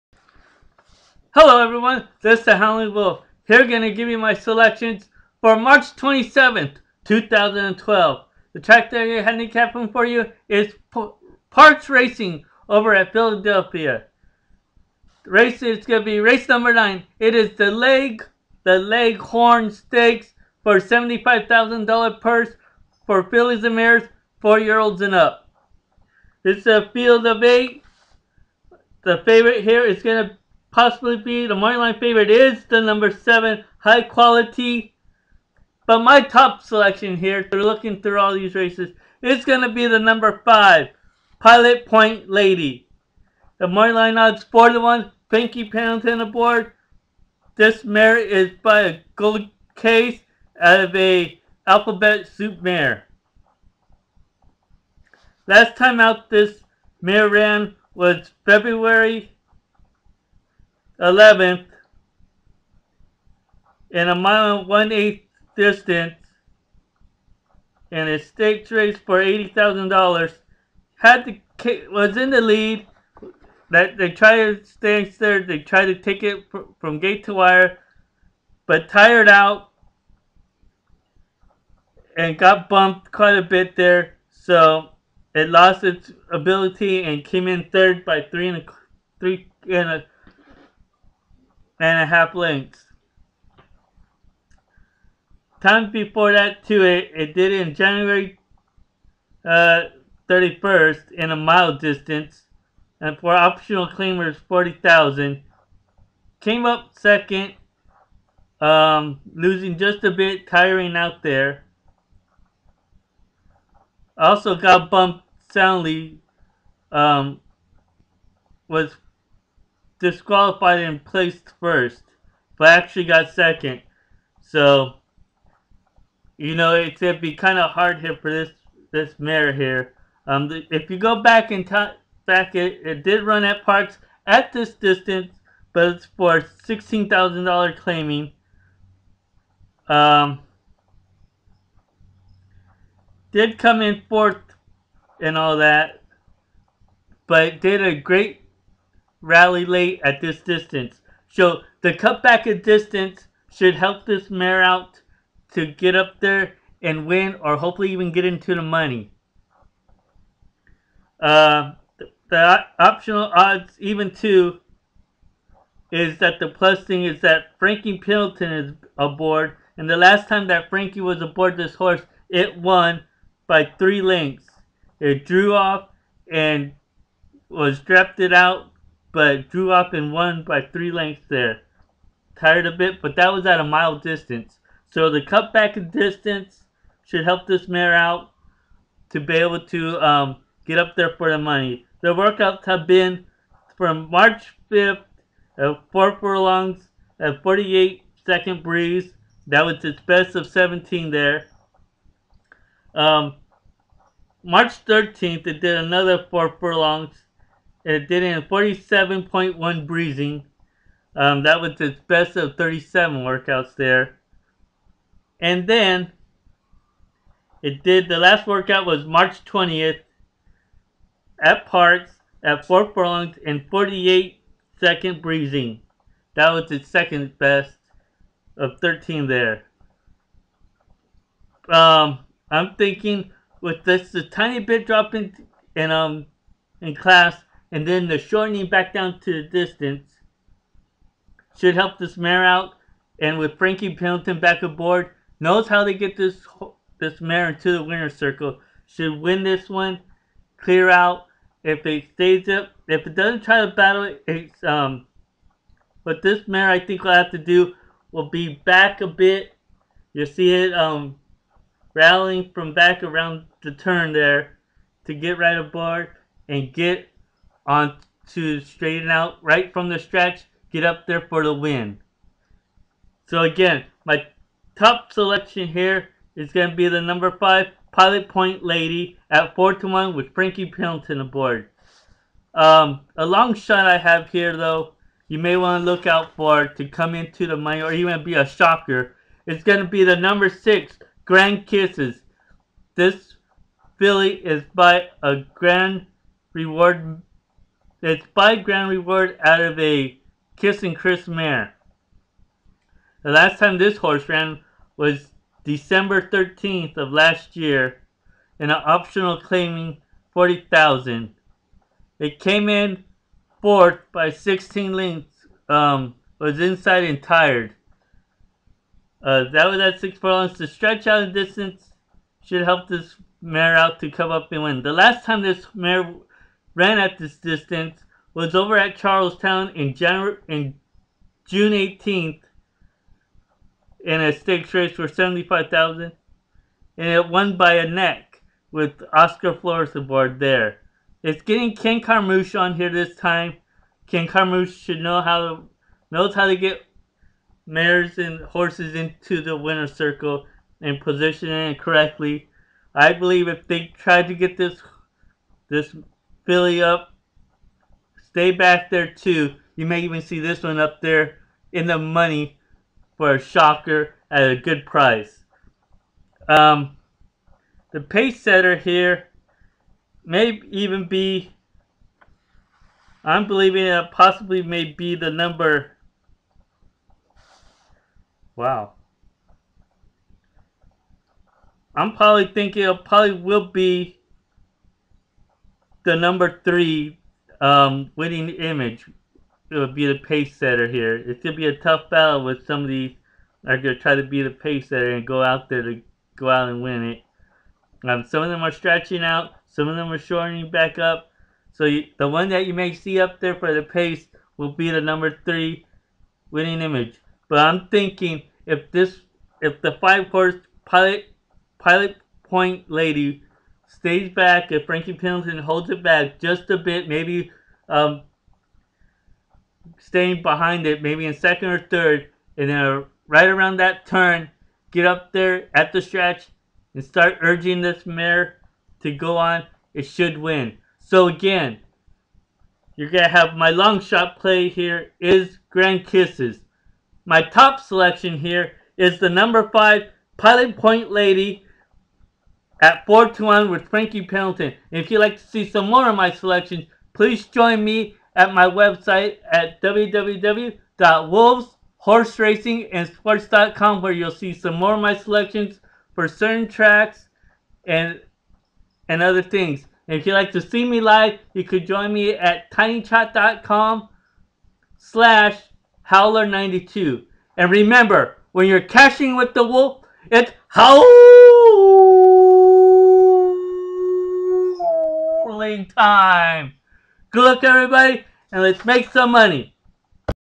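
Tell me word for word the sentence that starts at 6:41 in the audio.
So you, the one that you may see up there for the pace will be the number three winning image.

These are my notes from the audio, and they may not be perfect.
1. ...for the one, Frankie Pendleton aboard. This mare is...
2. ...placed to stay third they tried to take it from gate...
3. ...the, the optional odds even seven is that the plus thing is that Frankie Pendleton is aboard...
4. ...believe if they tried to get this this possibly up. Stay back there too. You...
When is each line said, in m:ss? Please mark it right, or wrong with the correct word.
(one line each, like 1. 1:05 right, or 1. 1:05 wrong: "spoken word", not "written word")
1. 0:44 right
2. 1:14 wrong: "tried", not "placed"
3. 2:41 wrong: "two", not "seven"
4. 5:53 wrong: "filly", not "possibly".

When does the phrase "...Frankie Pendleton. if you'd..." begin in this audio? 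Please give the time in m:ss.
7:23.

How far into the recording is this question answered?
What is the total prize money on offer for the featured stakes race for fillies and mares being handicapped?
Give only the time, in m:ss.
0:20.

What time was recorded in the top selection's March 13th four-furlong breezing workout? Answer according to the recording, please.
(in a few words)
47.1.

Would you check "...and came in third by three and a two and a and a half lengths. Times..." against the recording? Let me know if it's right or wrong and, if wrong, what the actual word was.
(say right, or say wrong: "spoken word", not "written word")
wrong: "three", not "two".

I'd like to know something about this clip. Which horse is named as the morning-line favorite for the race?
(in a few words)
High Quality.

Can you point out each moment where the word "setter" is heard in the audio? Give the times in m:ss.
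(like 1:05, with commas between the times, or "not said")
6:08, 6:30, 6:34.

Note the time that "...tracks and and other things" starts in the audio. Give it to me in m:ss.
7:36.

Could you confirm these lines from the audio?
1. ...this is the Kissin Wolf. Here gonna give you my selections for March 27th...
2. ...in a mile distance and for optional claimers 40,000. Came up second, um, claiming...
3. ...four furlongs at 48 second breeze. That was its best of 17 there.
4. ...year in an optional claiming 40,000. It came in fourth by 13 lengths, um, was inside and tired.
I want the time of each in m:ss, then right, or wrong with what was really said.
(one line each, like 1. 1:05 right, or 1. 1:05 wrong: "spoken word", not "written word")
1. 0:02 wrong: "Howling", not "Kissin"
2. 1:41 wrong: "losing", not "claiming"
3. 3:15 right
4. 5:07 wrong: "16", not "13".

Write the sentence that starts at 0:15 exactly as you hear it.
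The race is gonna be race number nine.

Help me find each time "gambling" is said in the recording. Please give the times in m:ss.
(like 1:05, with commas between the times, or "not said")
7:55.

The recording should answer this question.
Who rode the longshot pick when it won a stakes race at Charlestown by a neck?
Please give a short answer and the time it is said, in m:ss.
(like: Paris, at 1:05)
Oscar Flores, at 5:39.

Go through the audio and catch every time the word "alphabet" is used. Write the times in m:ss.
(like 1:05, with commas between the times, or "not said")
0:51.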